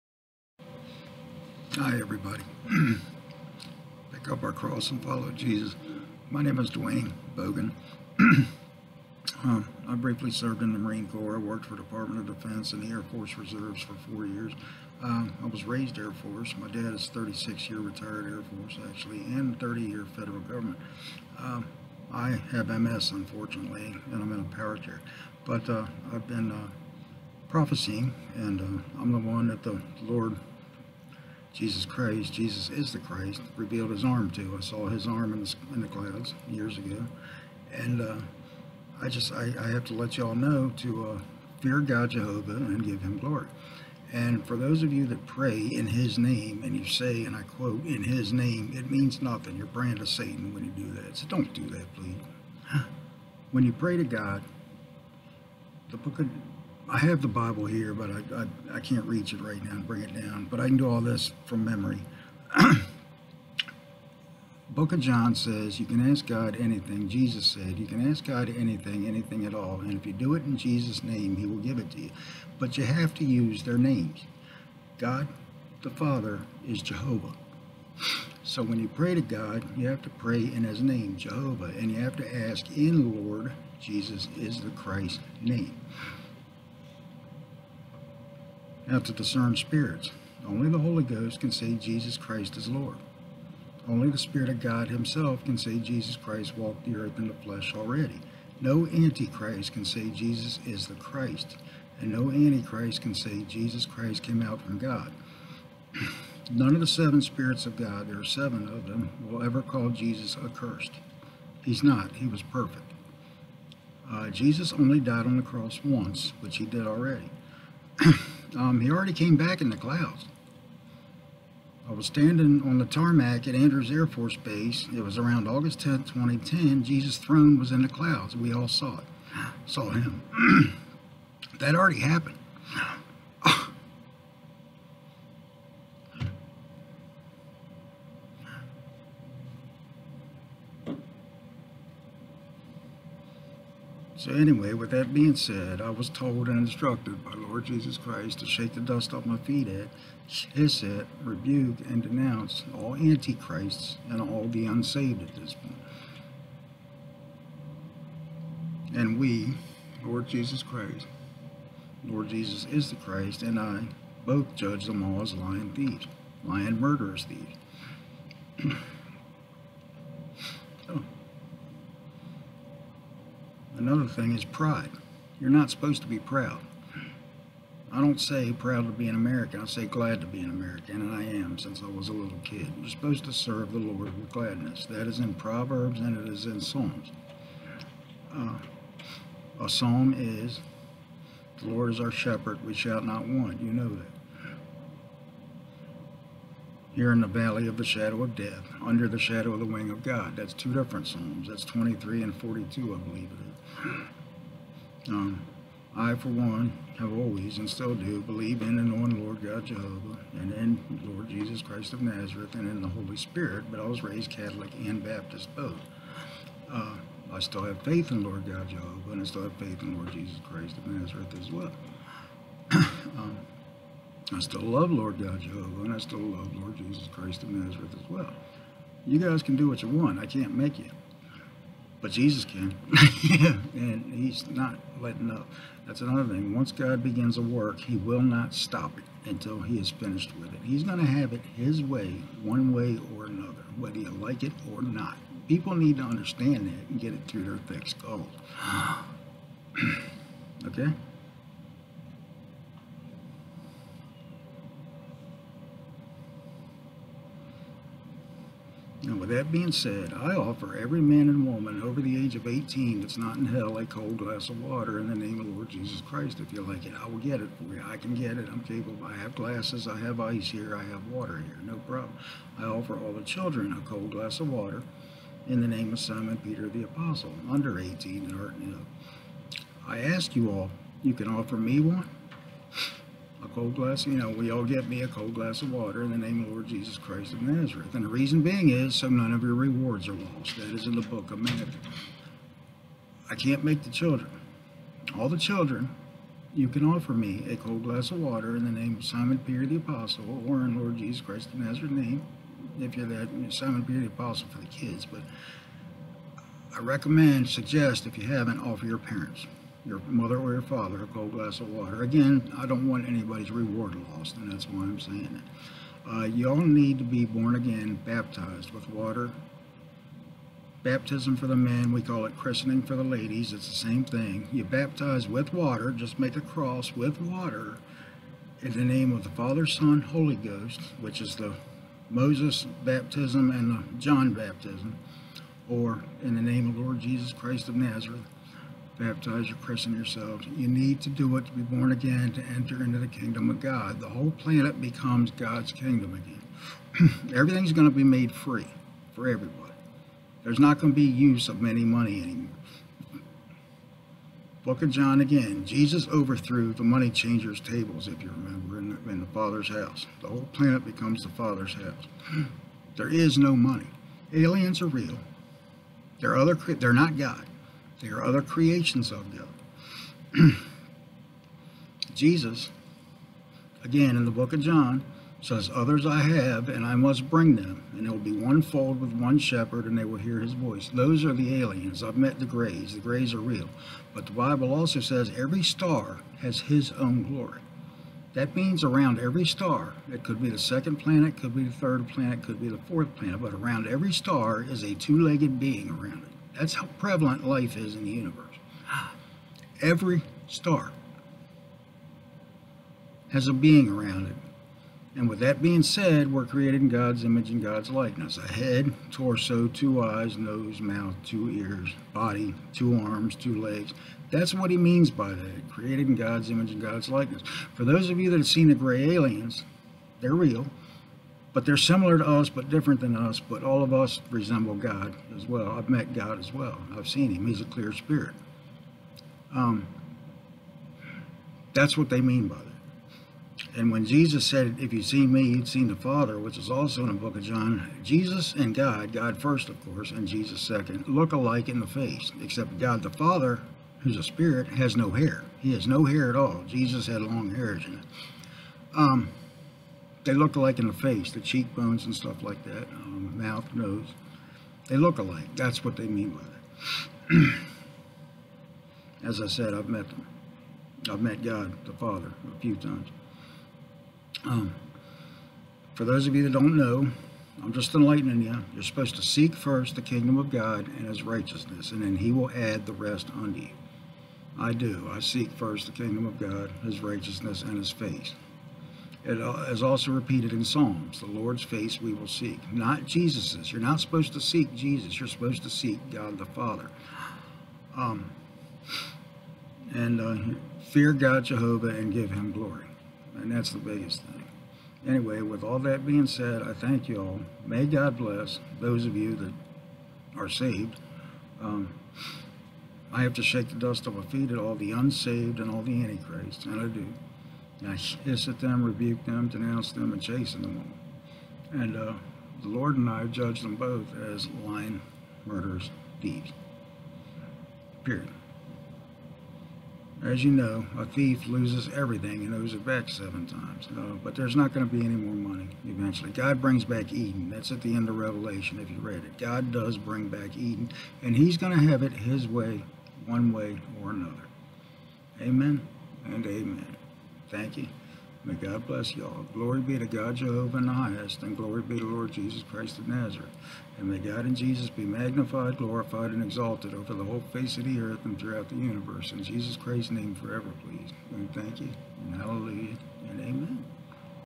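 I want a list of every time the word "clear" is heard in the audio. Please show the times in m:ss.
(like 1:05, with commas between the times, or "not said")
7:07.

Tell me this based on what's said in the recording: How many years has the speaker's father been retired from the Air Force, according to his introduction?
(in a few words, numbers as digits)
36.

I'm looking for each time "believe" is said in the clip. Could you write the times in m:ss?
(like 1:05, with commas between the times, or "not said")
3:23, 3:28.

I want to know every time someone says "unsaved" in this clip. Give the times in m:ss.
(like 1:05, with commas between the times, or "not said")
2:34, 8:24.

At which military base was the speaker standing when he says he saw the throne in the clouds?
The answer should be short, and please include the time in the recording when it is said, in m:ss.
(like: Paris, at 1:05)
Andrews Air Force Base, at 2:03.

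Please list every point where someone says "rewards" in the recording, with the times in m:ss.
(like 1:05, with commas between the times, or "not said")
4:49, 5:13.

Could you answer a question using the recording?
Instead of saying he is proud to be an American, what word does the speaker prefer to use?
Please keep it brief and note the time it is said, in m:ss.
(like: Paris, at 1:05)
Glad, at 2:59.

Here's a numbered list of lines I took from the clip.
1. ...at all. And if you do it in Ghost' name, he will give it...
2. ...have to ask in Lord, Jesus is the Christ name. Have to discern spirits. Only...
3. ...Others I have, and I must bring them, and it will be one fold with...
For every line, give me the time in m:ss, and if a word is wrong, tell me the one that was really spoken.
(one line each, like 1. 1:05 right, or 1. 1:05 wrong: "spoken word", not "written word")
1. 1:09 wrong: "Jesus", not "Ghost"
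2. 1:22 right
3. 6:15 right.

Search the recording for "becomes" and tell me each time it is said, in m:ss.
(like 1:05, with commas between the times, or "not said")
5:44, 6:00.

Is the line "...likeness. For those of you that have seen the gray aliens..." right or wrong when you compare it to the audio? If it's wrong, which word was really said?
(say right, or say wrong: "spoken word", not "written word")
right.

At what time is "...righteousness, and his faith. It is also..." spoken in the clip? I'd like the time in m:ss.
7:57.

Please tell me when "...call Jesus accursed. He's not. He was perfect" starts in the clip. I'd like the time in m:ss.
1:49.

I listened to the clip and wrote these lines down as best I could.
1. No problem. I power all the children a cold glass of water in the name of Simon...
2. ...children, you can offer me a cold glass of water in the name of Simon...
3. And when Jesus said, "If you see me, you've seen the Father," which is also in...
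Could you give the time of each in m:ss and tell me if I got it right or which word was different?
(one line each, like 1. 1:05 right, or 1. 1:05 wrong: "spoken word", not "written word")
1. 4:31 wrong: "offer", not "power"
2. 4:55 right
3. 7:13 right.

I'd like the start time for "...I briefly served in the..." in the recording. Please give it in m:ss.
0:09.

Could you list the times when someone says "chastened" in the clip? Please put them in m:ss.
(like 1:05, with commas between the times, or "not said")
8:30.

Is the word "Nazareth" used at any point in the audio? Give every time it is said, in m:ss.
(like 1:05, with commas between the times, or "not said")
3:32, 3:40, 3:47, 4:47, 5:01, 5:37, 9:03.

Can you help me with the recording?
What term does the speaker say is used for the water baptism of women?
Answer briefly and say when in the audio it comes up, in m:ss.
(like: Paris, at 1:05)
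Christening, at 5:22.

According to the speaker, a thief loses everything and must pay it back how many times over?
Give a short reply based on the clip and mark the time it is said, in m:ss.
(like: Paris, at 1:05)
7, at 8:43.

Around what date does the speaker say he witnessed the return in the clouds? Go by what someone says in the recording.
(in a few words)
August 10, 2010.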